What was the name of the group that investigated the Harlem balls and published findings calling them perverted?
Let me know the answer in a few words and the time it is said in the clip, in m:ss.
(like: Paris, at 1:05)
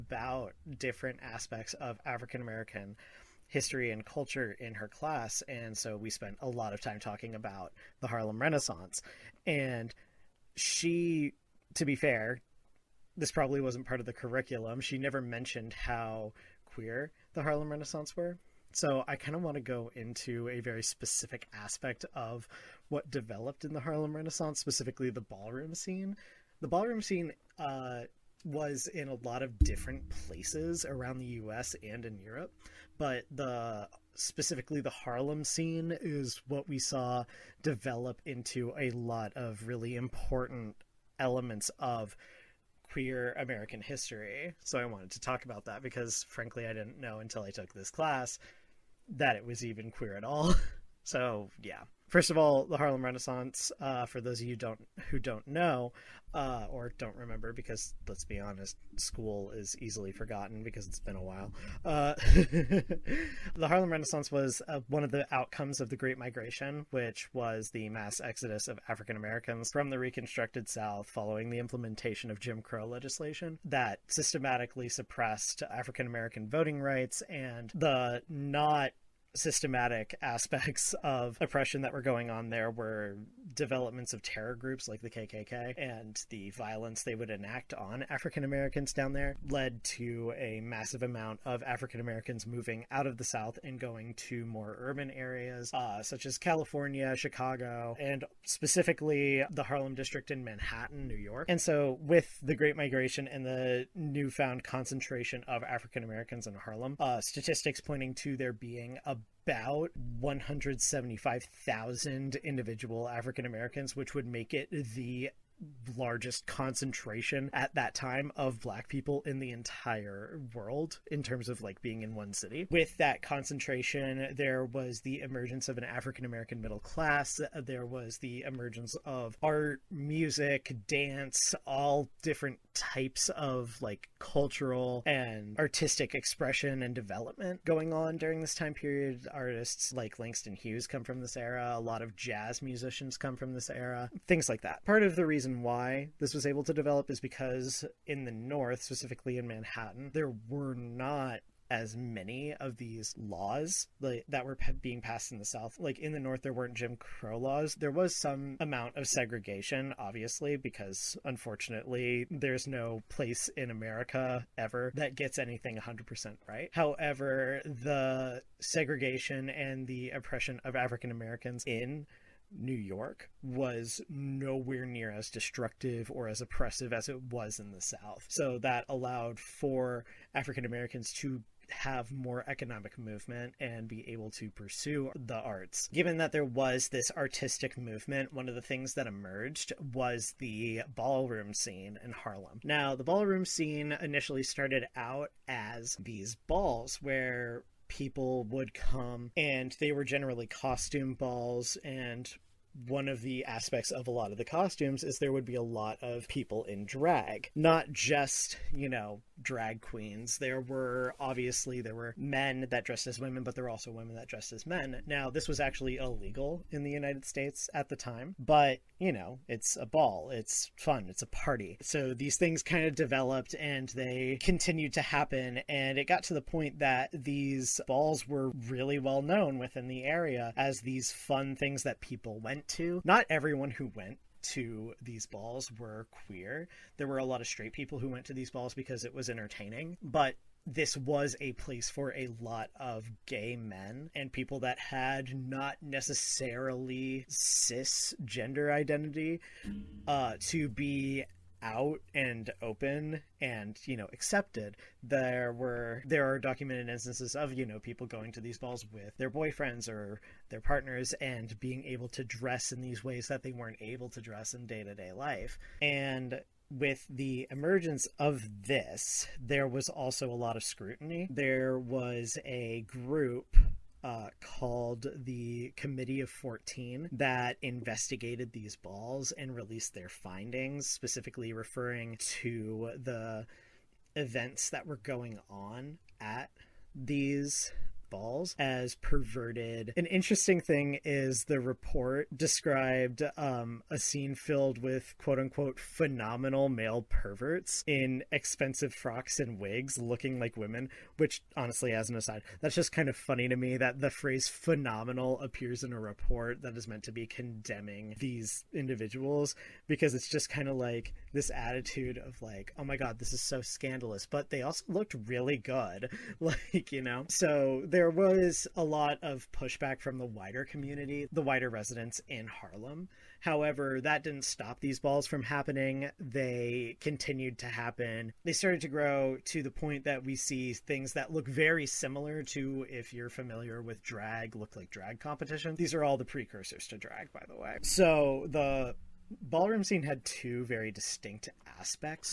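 Committee of 14, at 4:35.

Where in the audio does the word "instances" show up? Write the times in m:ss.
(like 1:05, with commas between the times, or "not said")
4:16.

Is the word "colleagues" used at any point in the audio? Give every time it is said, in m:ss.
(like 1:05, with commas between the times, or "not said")
not said.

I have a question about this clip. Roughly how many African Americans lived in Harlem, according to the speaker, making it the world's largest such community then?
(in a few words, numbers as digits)
175,000.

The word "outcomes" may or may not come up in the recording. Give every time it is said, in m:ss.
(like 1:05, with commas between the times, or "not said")
1:05.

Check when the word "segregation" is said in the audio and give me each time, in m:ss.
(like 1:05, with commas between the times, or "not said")
2:39, 2:48.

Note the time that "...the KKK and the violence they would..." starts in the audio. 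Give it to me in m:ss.
1:25.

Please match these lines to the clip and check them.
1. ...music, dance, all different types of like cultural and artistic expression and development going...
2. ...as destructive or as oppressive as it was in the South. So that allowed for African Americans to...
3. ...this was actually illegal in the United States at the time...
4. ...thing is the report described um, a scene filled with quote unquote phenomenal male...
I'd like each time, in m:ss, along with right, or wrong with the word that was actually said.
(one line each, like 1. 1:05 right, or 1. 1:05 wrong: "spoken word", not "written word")
1. 2:09 right
2. 2:55 right
3. 3:35 right
4. 4:50 right.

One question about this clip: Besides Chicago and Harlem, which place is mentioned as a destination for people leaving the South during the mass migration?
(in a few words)
California.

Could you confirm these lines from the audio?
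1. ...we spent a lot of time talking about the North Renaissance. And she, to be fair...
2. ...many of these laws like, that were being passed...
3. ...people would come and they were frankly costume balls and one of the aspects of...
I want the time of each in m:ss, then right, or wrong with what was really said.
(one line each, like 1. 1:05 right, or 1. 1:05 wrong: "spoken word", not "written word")
1. 0:05 wrong: "Harlem", not "North"
2. 2:31 right
3. 3:17 wrong: "generally", not "frankly".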